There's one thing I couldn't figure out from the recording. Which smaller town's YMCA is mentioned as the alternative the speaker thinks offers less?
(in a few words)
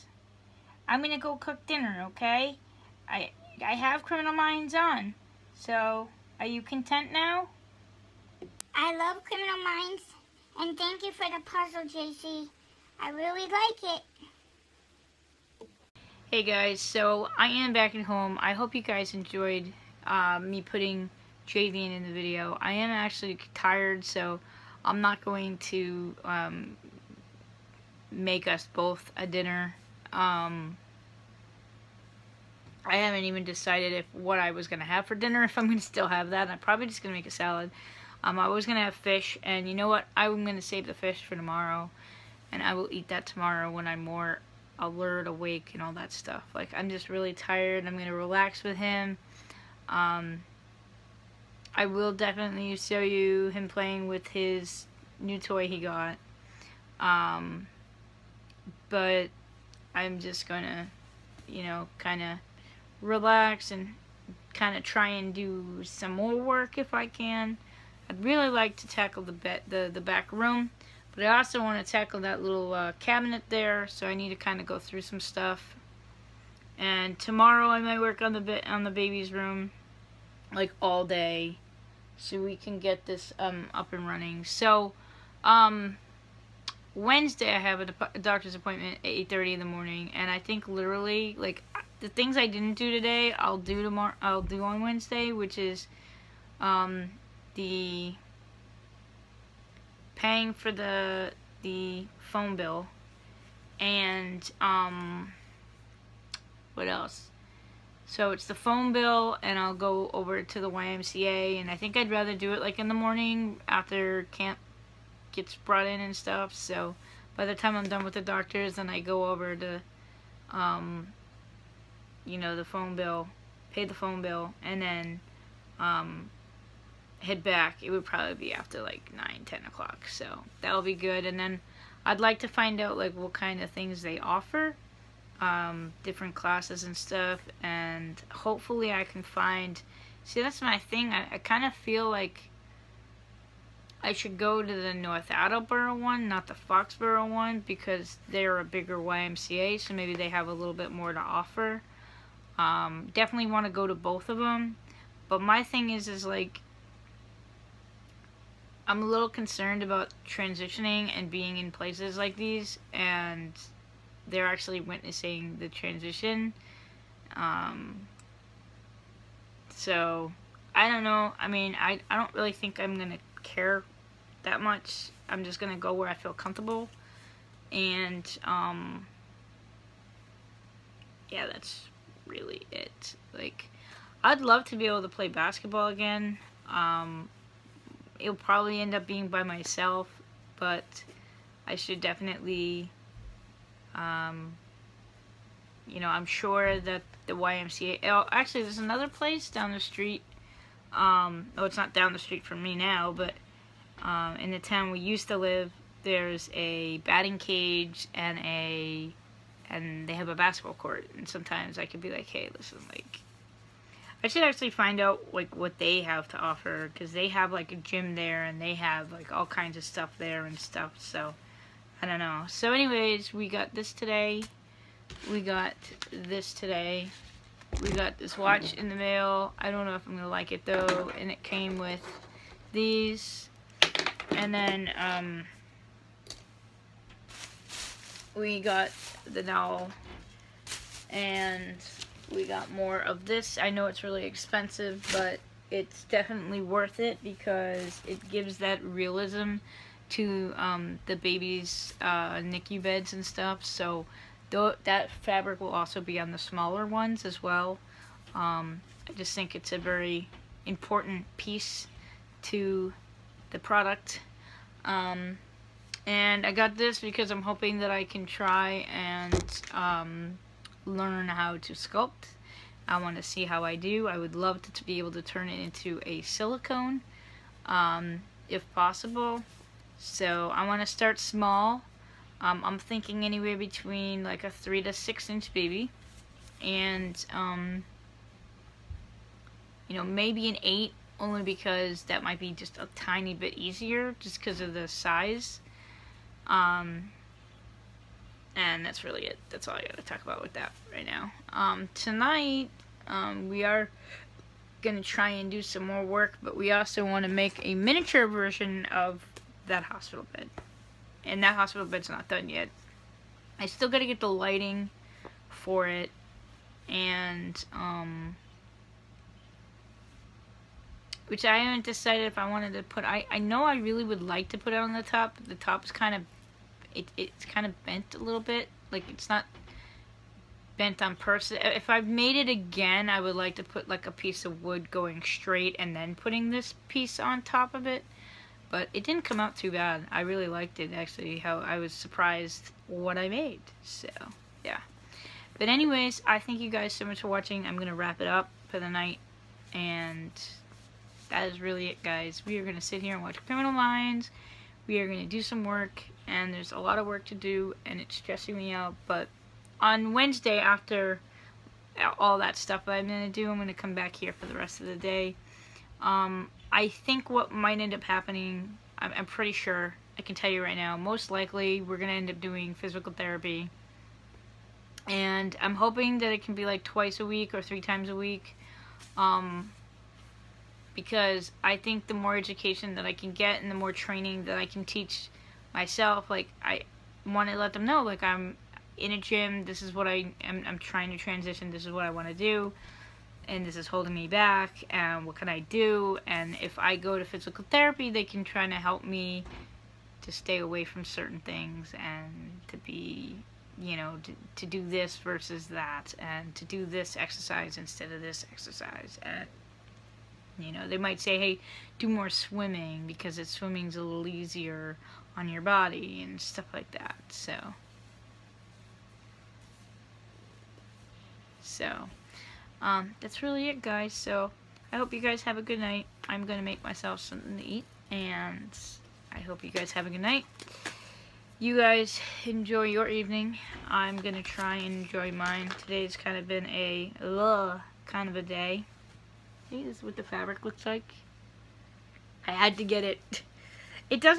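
Foxboro.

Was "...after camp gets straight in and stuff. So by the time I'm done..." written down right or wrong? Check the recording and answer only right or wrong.
wrong.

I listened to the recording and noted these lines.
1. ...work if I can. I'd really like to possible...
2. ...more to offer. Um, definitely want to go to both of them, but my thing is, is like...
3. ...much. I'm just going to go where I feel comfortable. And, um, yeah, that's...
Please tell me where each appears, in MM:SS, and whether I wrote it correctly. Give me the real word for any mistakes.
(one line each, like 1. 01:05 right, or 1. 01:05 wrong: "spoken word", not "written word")
1. 01:06 wrong: "tackle", not "possible"
2. 02:30 right
3. 02:54 right.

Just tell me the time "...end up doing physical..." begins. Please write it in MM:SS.
06:12.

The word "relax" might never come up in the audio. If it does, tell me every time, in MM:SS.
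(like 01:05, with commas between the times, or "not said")
00:48, 01:03.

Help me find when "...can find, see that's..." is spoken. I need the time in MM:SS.
02:19.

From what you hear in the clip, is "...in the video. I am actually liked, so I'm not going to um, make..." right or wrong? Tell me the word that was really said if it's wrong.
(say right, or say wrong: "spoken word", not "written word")
wrong: "tired", not "liked".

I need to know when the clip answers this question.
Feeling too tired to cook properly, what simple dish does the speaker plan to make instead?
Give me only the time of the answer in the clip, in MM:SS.
00:37.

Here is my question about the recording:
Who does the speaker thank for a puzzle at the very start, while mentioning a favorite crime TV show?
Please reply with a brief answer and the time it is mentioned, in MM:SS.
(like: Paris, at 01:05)
JC, at 00:11.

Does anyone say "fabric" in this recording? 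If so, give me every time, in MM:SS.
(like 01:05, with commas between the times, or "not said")
04:15, 07:20.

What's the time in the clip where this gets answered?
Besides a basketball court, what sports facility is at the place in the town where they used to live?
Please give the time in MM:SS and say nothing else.
03:26.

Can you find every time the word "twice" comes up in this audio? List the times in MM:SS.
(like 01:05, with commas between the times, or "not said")
06:16.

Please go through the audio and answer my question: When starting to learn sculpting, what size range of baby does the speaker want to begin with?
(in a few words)
3 to 6 inch.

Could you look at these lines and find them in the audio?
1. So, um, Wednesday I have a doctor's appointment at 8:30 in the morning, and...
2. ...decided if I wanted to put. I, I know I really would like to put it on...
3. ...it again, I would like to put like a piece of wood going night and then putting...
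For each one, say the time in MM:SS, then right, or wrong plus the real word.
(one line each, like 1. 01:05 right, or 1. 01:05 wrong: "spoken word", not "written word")
1. 01:24 right
2. 05:21 right
3. 05:32 wrong: "straight", not "night".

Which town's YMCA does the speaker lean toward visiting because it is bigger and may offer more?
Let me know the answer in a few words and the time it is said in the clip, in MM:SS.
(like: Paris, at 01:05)
North Attleboro, at 02:24.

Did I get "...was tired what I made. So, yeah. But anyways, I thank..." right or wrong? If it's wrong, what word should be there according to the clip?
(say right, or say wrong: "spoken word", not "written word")
wrong: "surprised", not "tired".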